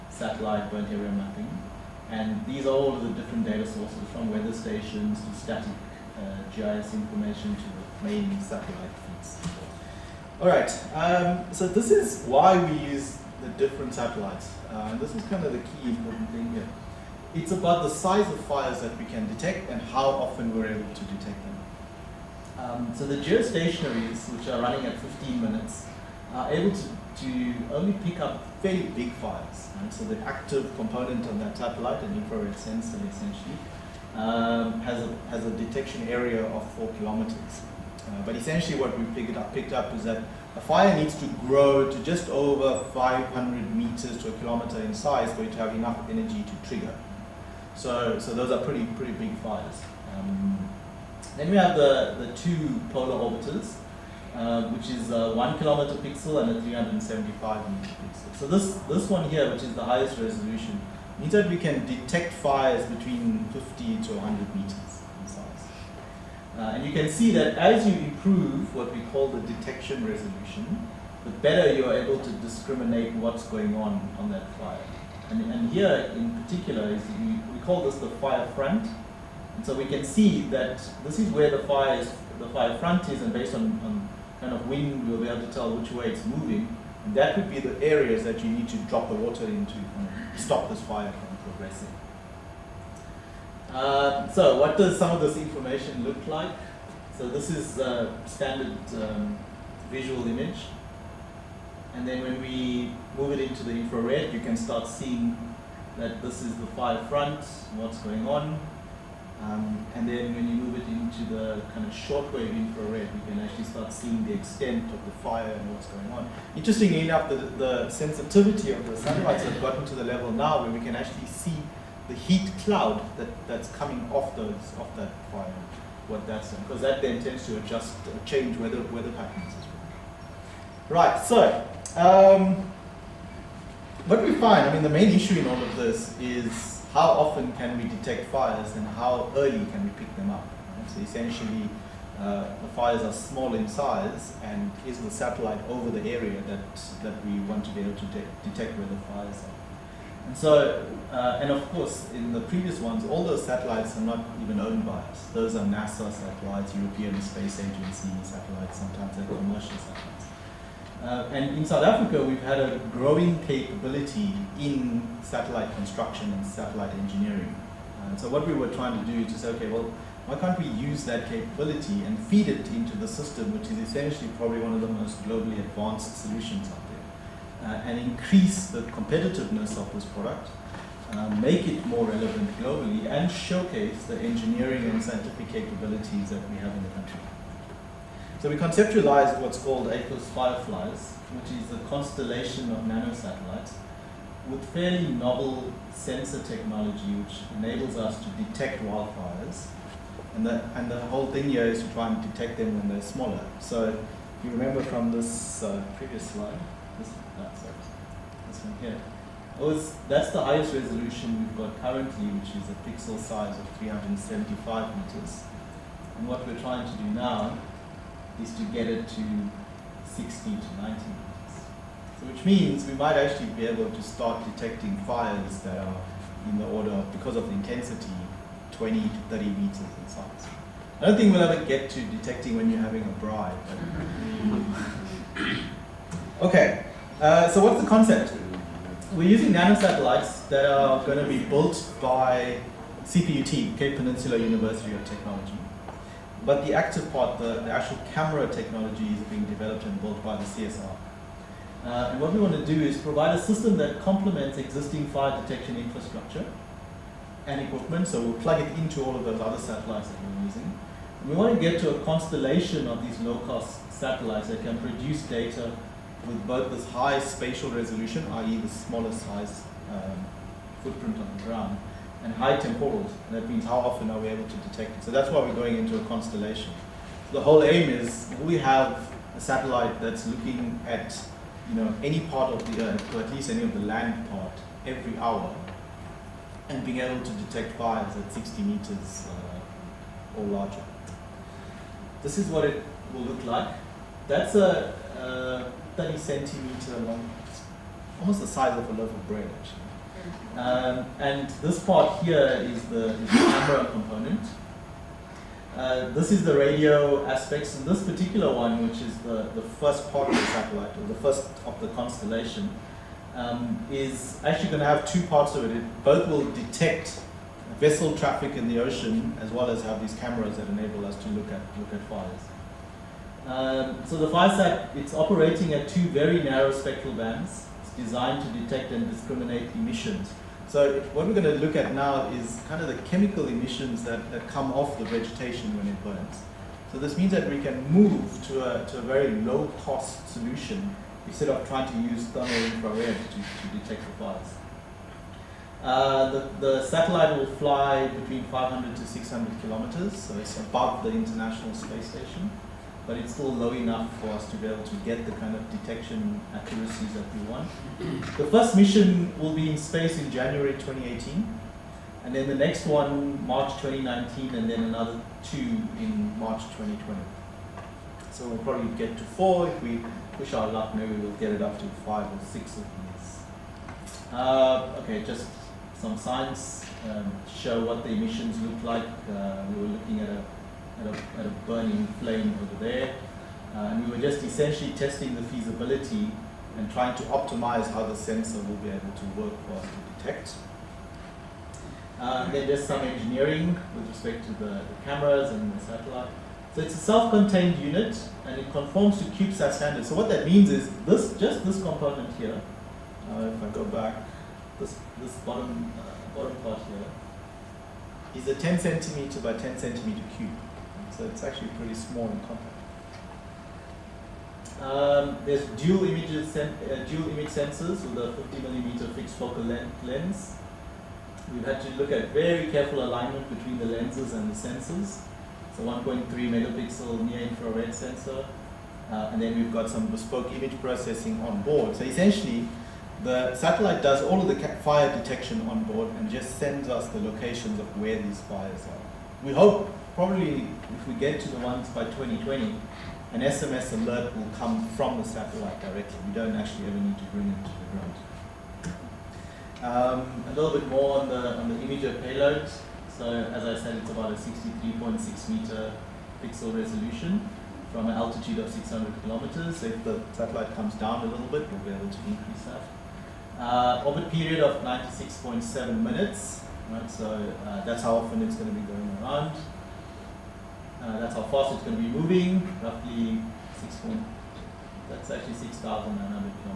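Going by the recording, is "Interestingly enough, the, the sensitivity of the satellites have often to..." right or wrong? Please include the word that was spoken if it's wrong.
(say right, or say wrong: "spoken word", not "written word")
wrong: "gotten", not "often".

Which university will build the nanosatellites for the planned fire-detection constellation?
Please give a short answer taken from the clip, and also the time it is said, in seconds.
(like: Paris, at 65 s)
Cape Peninsula University of Technology, at 243 s.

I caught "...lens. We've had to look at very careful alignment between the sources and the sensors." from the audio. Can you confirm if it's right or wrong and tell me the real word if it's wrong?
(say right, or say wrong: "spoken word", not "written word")
wrong: "lenses", not "sources".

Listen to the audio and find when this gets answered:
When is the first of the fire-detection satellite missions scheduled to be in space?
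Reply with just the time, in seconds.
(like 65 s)
360 s.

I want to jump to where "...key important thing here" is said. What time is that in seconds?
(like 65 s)
15 s.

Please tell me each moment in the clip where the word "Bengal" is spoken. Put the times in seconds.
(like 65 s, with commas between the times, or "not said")
not said.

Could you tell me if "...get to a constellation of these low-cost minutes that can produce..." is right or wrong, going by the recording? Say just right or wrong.
wrong.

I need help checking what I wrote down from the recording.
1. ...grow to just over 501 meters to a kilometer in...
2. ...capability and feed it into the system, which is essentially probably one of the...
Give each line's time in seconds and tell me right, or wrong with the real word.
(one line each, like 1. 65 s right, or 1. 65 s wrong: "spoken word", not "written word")
1. 41 s wrong: "500", not "501"
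2. 171 s right.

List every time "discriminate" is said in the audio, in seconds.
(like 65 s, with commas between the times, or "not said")
72 s, 329 s.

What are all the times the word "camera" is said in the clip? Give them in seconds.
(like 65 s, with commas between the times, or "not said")
248 s, 303 s, 320 s, 395 s.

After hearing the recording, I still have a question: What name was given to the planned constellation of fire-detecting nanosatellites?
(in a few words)
AFIS Fireflies.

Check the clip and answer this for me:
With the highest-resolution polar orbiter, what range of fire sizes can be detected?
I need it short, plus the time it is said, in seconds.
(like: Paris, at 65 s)
50 to 100 meters, at 63 s.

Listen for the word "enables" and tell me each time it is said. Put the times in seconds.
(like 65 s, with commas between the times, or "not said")
197 s, 320 s.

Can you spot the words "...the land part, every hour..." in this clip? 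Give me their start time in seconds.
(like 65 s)
283 s.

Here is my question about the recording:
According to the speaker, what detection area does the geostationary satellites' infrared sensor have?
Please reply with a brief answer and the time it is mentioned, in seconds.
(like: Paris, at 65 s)
4 kilometers, at 36 s.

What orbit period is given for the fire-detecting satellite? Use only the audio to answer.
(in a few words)
96.7 minutes.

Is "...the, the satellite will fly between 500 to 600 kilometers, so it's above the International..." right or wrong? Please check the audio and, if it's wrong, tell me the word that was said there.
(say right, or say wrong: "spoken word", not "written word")
right.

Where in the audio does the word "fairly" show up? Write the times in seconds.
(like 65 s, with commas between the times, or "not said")
28 s, 194 s.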